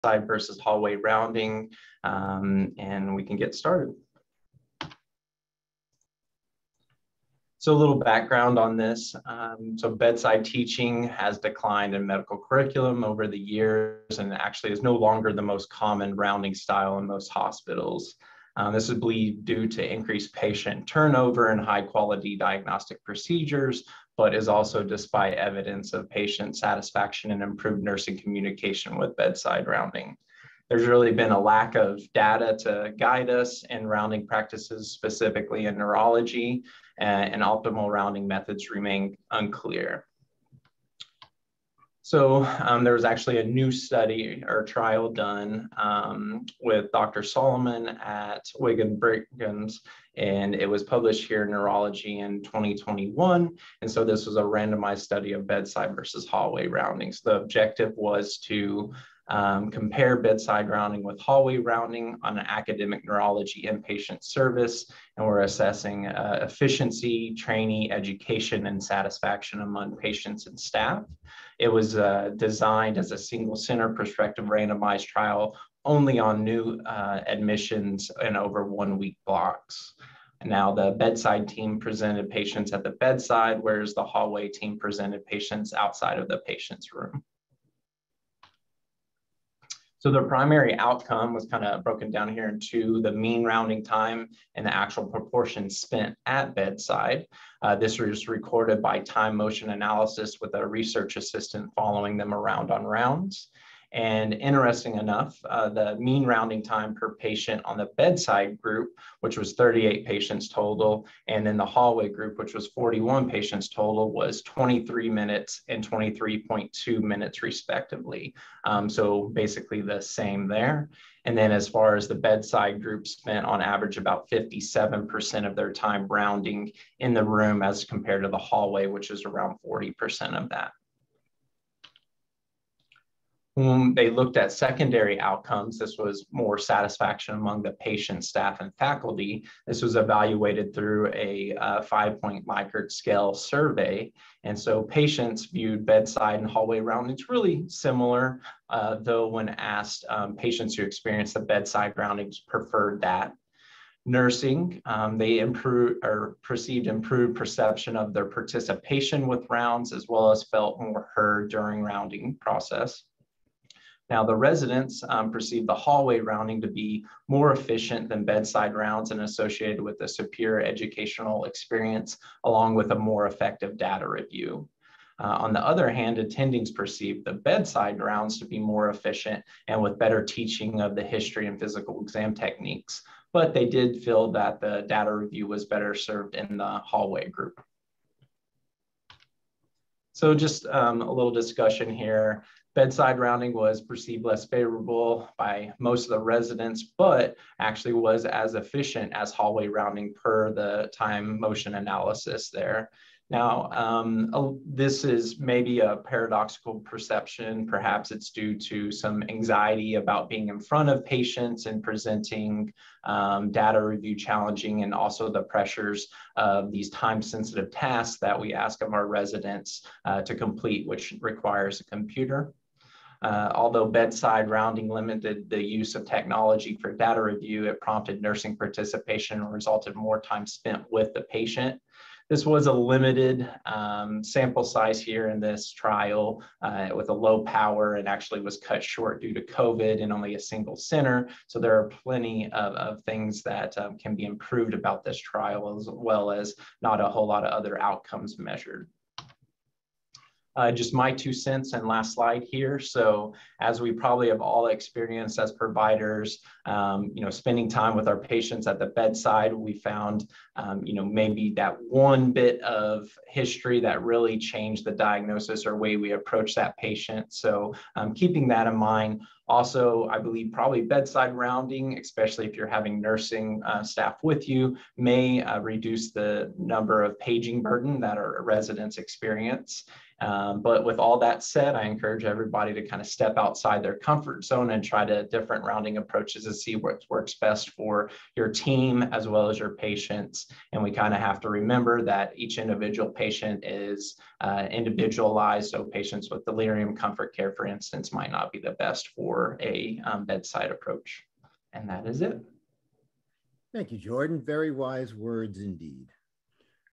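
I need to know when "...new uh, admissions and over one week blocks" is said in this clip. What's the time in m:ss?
1:16.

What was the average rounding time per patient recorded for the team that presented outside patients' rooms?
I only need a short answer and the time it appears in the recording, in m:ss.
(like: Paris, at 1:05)
23.2 minutes, at 1:55.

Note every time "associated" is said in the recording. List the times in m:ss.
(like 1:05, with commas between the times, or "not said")
2:49.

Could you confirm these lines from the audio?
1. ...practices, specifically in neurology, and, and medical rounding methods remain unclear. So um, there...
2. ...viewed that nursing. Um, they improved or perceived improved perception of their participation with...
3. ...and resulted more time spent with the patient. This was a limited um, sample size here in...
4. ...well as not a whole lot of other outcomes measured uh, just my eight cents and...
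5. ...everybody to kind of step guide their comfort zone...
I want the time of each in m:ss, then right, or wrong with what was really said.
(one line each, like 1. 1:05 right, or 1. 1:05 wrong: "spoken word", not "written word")
1. 0:34 wrong: "optimal", not "medical"
2. 2:32 wrong: "preferred", not "viewed"
3. 3:49 right
4. 4:05 wrong: "two", not "eight"
5. 4:42 wrong: "outside", not "guide".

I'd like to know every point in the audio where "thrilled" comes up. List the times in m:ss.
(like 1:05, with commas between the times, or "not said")
not said.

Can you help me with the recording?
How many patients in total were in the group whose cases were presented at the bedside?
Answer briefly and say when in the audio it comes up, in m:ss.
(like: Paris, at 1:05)
38, at 1:49.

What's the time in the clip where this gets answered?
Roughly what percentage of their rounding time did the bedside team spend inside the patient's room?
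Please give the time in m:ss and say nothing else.
2:04.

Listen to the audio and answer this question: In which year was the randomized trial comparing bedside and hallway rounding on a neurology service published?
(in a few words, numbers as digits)
2021.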